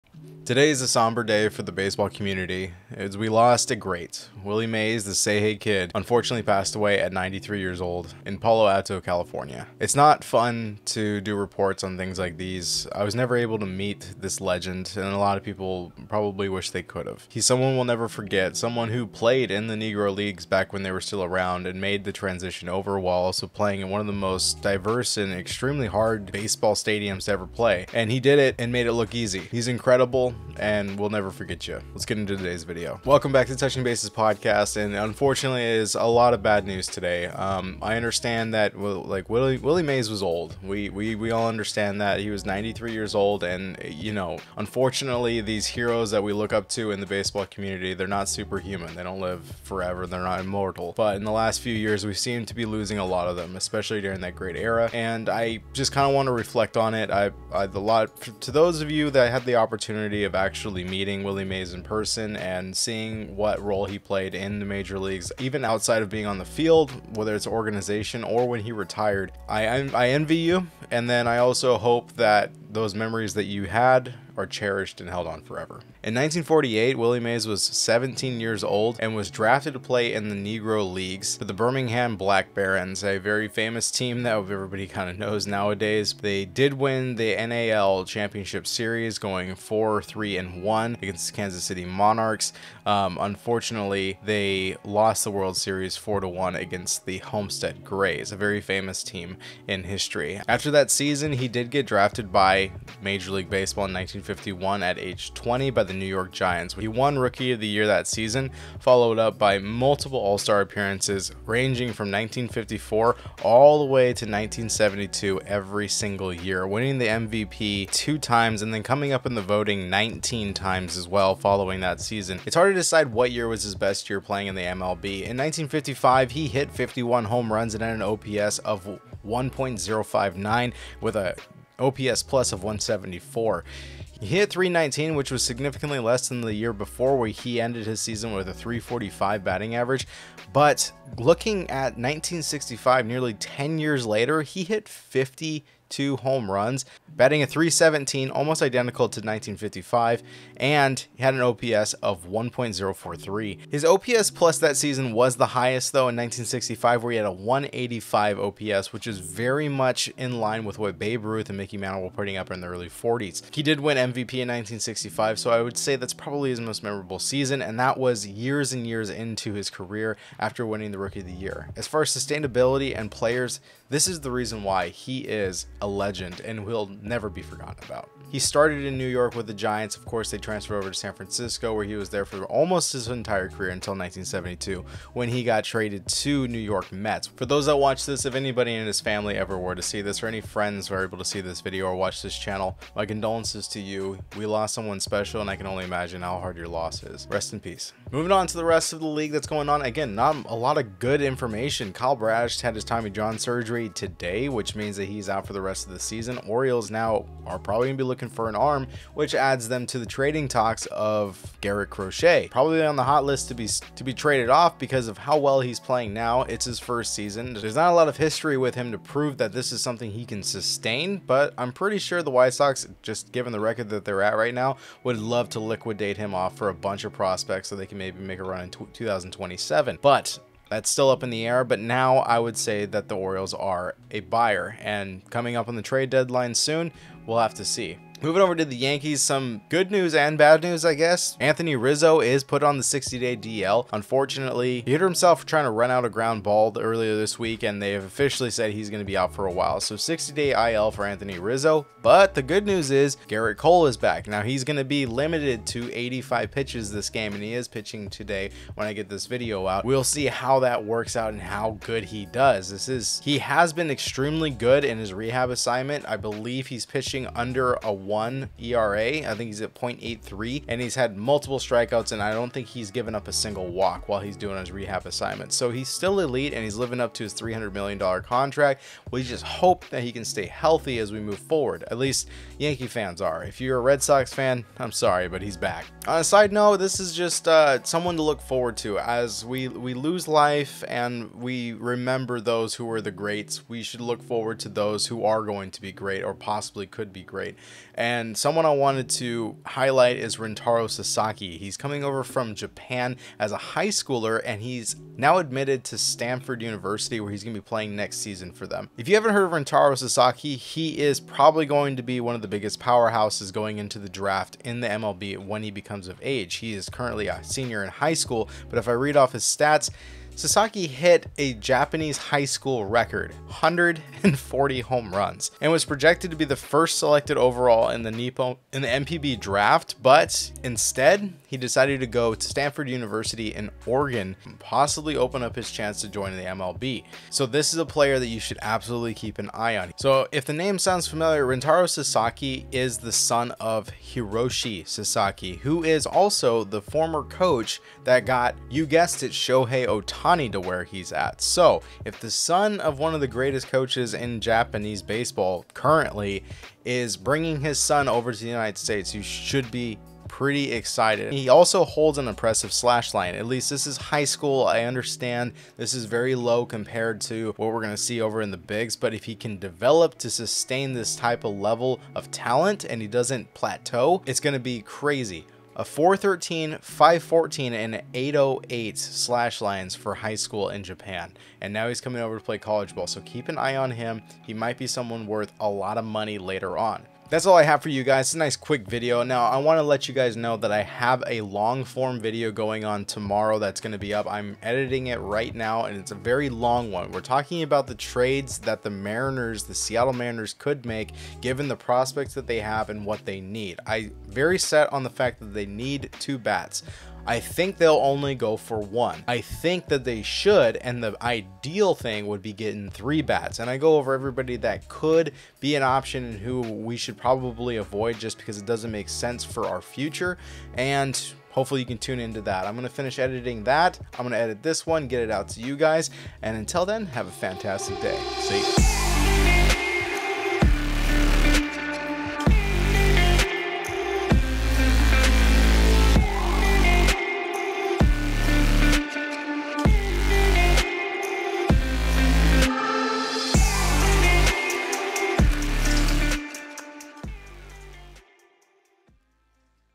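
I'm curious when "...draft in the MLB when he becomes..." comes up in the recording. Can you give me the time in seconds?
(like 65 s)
314 s.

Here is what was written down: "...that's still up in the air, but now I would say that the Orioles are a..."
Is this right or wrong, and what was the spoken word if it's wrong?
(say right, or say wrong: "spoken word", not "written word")
right.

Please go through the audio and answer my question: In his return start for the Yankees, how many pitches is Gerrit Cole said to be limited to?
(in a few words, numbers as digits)
85.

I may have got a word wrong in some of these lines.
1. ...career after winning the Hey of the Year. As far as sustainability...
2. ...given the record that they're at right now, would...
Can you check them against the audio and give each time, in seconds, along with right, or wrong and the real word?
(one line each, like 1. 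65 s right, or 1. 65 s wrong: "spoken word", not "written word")
1. 169 s wrong: "Rookie", not "Hey"
2. 223 s right.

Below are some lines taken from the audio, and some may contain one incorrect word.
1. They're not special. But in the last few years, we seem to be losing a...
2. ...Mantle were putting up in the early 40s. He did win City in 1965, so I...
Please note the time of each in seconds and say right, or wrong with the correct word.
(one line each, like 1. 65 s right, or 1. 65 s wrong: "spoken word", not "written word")
1. 50 s wrong: "immortal", not "special"
2. 161 s wrong: "MVP", not "City".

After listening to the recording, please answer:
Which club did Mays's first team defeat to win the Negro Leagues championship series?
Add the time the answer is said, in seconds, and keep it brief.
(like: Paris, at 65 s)
Kansas City Monarchs, at 91 s.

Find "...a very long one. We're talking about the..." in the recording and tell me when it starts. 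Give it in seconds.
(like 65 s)
396 s.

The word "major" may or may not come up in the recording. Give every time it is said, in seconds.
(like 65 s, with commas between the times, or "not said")
64 s, 103 s.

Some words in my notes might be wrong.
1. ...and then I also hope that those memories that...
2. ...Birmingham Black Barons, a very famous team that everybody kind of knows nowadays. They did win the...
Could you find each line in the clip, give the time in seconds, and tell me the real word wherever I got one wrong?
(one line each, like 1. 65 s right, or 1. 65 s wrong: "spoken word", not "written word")
1. 70 s right
2. 81 s right.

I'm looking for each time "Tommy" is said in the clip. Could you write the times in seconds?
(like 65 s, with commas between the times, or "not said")
202 s.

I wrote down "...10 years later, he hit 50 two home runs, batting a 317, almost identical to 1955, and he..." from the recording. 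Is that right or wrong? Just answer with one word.
right.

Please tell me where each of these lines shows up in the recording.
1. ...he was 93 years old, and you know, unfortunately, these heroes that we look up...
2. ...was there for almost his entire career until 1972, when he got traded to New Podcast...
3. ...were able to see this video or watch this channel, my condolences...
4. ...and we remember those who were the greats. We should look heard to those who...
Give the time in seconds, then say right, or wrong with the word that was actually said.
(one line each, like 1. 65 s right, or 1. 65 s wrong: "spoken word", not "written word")
1. 42 s right
2. 181 s wrong: "York", not "Podcast"
3. 190 s right
4. 290 s wrong: "forward", not "heard".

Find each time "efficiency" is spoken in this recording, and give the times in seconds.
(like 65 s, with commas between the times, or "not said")
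not said.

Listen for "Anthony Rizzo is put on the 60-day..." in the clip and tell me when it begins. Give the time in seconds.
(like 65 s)
241 s.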